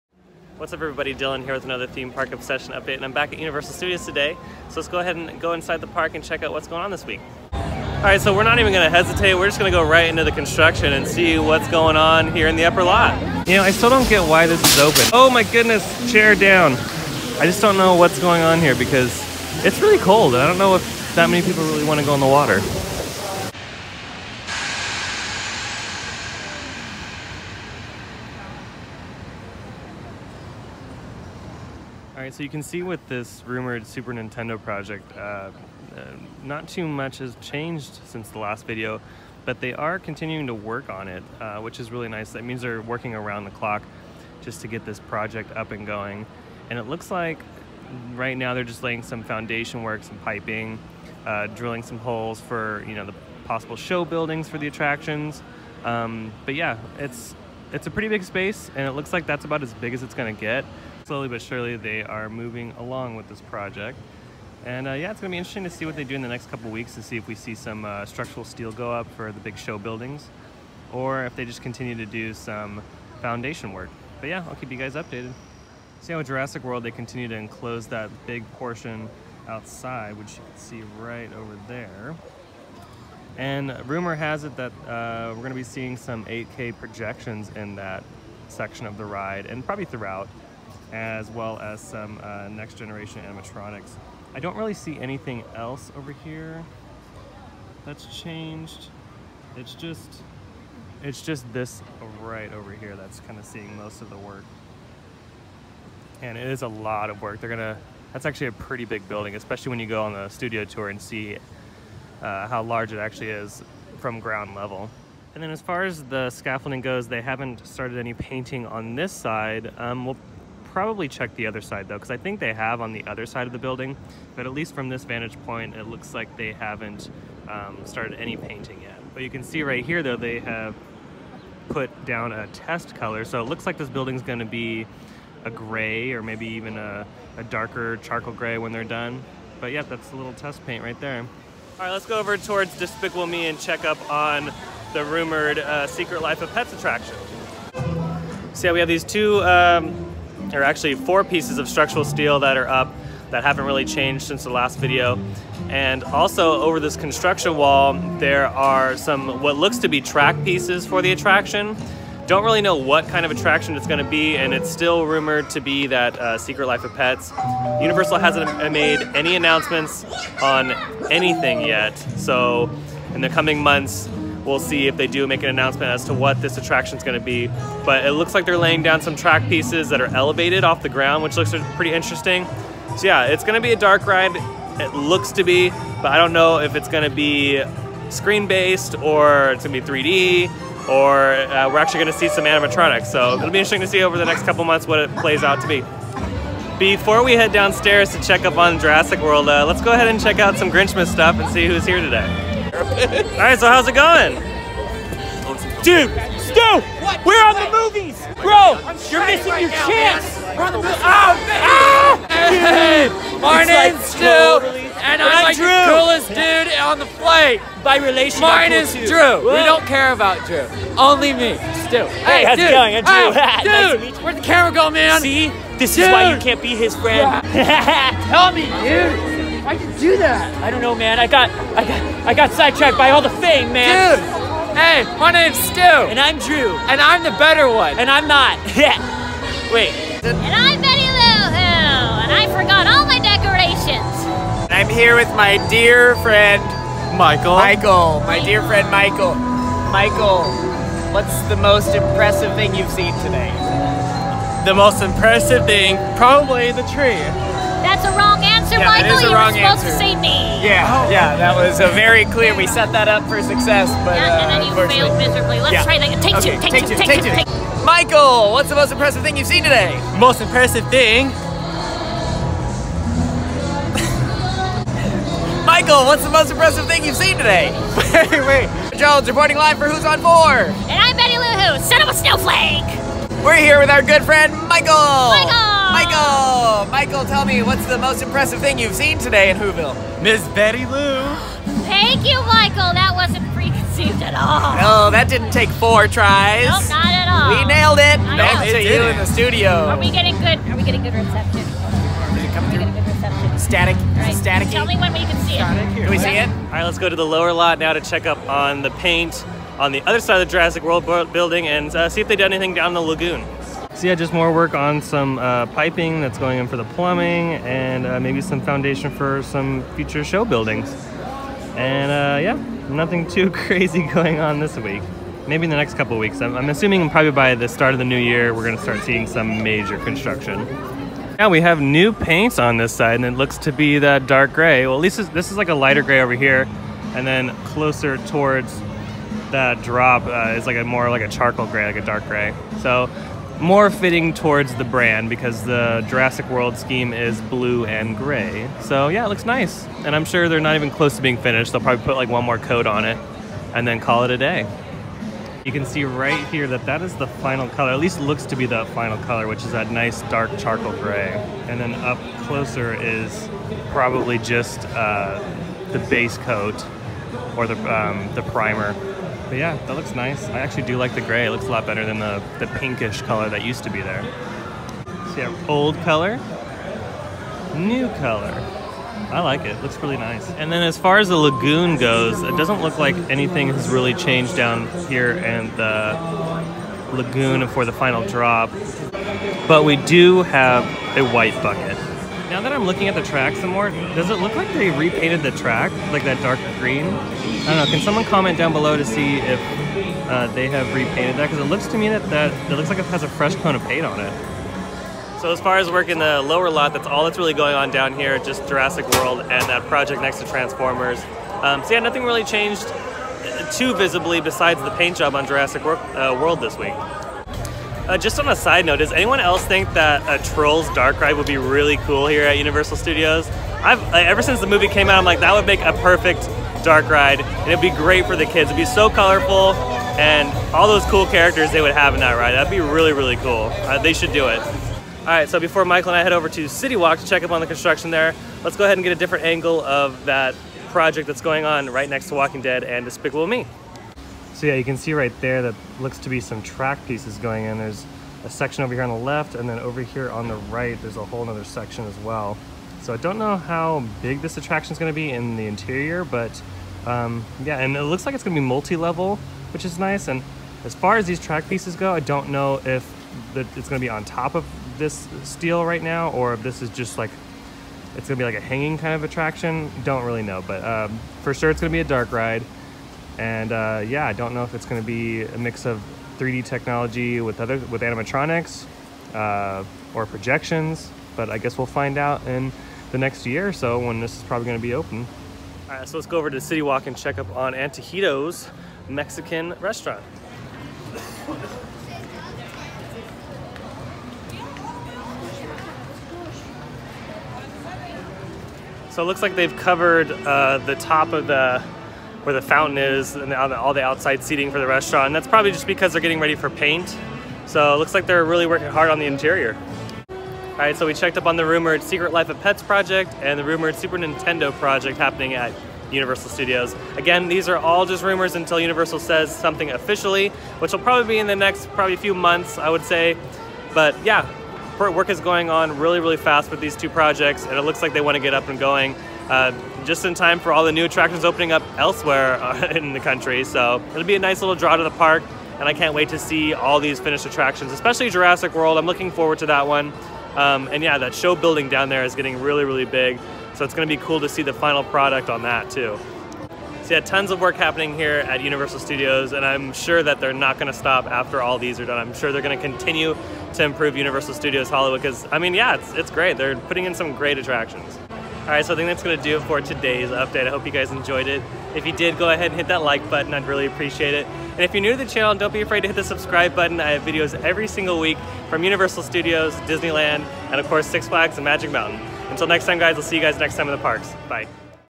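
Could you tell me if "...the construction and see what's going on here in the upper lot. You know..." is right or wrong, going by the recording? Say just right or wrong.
right.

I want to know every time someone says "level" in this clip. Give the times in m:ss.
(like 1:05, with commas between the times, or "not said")
1:54, 7:38.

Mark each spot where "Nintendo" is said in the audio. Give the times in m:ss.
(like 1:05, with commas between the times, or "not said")
0:34, 8:34.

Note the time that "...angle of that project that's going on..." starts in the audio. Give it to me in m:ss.
7:19.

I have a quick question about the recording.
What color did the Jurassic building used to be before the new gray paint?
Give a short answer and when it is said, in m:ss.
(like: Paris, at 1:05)
Pinkish, at 6:12.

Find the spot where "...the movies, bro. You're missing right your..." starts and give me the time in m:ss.
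3:27.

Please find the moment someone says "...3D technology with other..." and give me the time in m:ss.
7:56.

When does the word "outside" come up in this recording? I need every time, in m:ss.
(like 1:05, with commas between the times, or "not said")
1:19, 8:24.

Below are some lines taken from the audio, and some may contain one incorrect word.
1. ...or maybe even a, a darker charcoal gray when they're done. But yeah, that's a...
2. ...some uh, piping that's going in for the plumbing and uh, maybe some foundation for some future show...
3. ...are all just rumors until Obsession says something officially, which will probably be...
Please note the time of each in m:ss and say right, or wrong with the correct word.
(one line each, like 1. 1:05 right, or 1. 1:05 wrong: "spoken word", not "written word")
1. 2:16 right
2. 5:14 right
3. 8:37 wrong: "Universal", not "Obsession".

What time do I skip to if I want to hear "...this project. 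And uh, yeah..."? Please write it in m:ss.
1:03.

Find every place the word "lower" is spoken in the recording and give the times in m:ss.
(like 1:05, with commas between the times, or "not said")
5:07, 6:46.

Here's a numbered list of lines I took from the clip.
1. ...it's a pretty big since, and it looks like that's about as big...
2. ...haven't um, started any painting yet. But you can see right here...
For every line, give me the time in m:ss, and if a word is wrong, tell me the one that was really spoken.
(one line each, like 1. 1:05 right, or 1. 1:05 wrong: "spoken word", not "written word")
1. 0:57 wrong: "space", not "since"
2. 2:06 right.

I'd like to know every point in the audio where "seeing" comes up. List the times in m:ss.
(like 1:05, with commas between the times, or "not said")
1:25, 1:43, 5:29.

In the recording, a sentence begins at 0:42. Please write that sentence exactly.
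That means they're working around the clock just to get this project up and going.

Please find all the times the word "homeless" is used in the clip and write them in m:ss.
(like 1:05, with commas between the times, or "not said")
not said.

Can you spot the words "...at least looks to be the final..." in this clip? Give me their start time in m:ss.
5:57.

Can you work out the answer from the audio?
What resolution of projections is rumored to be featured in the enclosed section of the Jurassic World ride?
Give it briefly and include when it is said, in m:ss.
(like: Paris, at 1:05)
8K, at 1:26.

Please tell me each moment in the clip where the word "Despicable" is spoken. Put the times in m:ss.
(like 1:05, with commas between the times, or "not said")
2:22, 7:23.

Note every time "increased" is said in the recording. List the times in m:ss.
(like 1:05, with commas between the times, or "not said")
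not said.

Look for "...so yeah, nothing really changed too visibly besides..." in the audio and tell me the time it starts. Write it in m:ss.
6:51.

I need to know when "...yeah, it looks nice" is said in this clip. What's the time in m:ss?
5:49.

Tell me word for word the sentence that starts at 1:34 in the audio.
I don't really see anything else over here that's changed.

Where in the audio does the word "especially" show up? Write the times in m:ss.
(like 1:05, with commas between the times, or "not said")
1:49, 8:57.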